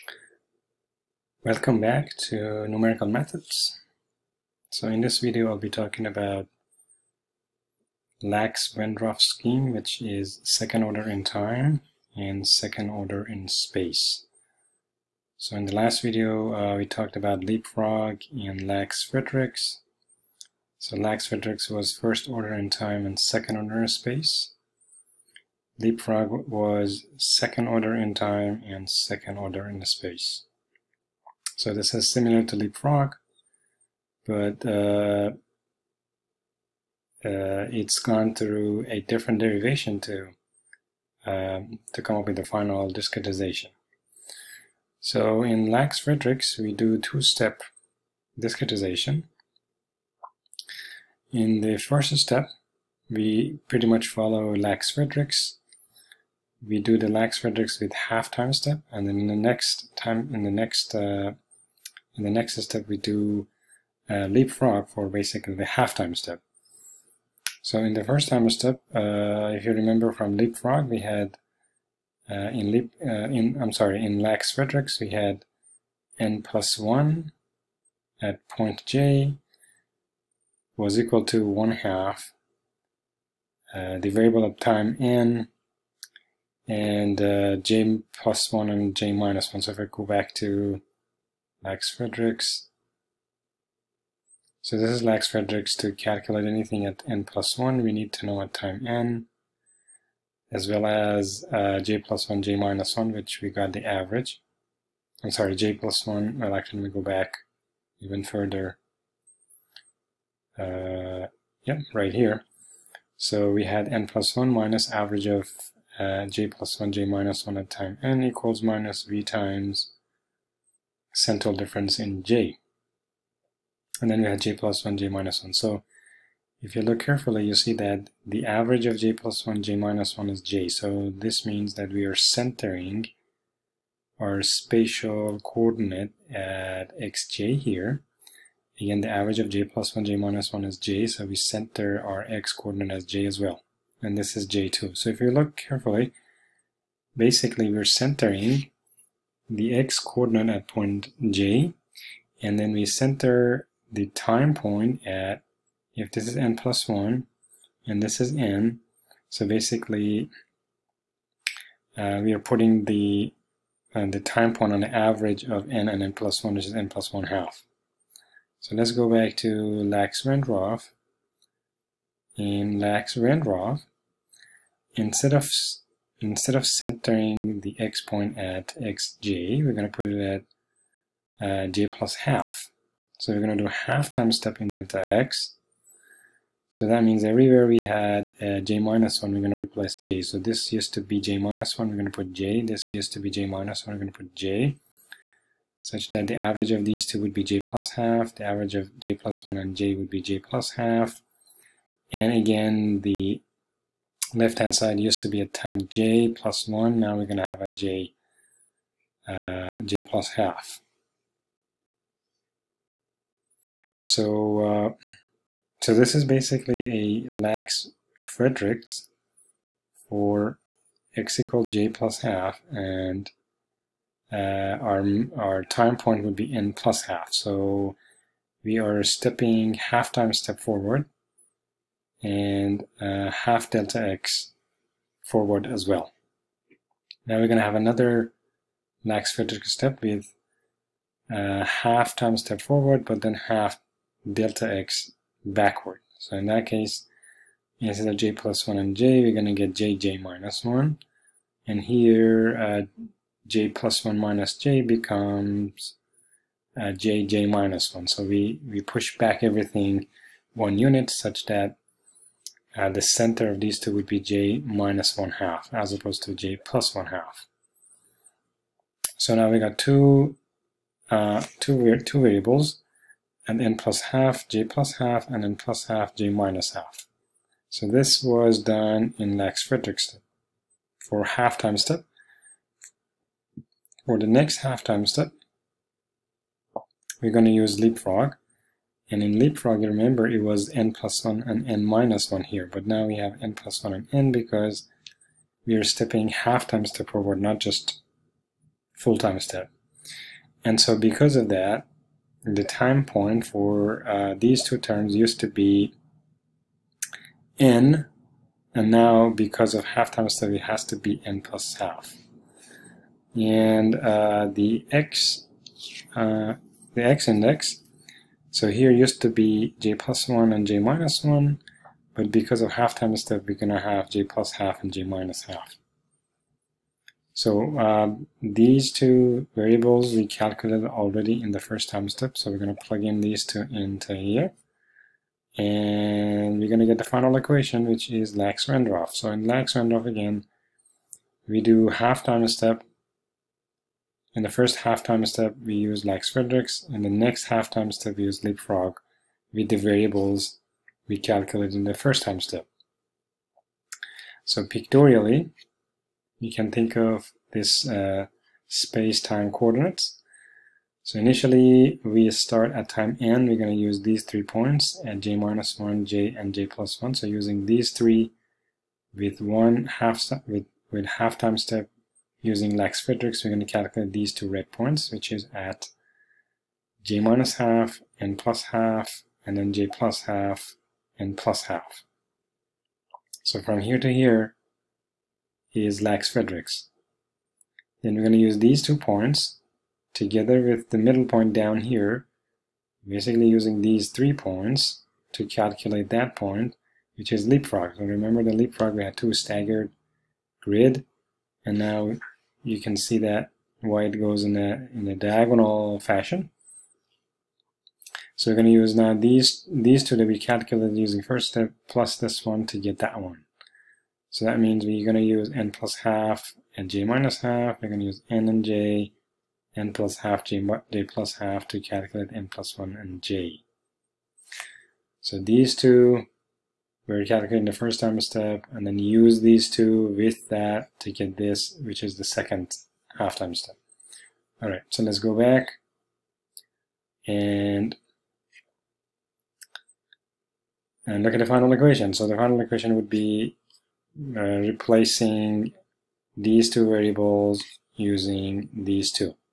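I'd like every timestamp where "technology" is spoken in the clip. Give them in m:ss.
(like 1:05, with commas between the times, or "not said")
not said.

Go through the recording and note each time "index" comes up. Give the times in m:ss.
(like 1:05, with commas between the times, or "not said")
5:17.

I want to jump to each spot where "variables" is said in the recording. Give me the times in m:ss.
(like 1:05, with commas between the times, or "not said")
1:24, 4:32, 5:29, 5:49, 7:26.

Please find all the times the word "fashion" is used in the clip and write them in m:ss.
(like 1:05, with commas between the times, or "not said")
6:45.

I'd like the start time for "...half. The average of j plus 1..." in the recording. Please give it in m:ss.
3:17.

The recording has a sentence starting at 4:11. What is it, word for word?
And here, uh, j plus 1 minus j becomes uh, jj minus 1.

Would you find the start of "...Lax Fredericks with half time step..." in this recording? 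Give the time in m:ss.
0:57.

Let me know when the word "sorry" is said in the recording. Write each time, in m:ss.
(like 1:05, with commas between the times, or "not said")
1:13, 1:45.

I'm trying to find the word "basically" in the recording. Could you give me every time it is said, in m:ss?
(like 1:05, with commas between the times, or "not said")
1:05, 2:27, 2:39, 3:36, 6:33.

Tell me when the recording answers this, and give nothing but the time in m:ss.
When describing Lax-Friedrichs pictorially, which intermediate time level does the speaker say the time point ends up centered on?
2:46.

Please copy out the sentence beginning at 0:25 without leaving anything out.
Leapfrog was second order in time and second order in space.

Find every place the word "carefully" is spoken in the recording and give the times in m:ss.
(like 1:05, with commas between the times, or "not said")
2:06, 2:25.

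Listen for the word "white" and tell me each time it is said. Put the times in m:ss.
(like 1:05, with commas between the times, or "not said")
6:43.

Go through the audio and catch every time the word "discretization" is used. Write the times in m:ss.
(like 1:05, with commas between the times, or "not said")
0:42, 0:48.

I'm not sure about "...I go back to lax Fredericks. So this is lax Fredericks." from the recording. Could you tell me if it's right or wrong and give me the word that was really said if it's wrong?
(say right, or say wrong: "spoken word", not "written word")
right.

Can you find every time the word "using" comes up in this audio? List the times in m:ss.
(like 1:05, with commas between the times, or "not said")
6:07, 6:12, 6:33, 6:50, 7:27.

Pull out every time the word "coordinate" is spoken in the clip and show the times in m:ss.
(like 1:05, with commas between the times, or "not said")
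2:15, 2:22, 2:29, 5:59.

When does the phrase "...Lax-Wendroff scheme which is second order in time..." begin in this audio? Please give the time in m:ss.
0:08.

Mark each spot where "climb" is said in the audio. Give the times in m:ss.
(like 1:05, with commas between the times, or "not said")
not said.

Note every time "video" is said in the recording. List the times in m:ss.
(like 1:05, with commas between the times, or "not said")
0:05, 0:16.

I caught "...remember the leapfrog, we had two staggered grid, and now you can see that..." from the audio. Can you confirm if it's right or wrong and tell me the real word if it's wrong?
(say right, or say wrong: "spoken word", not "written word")
right.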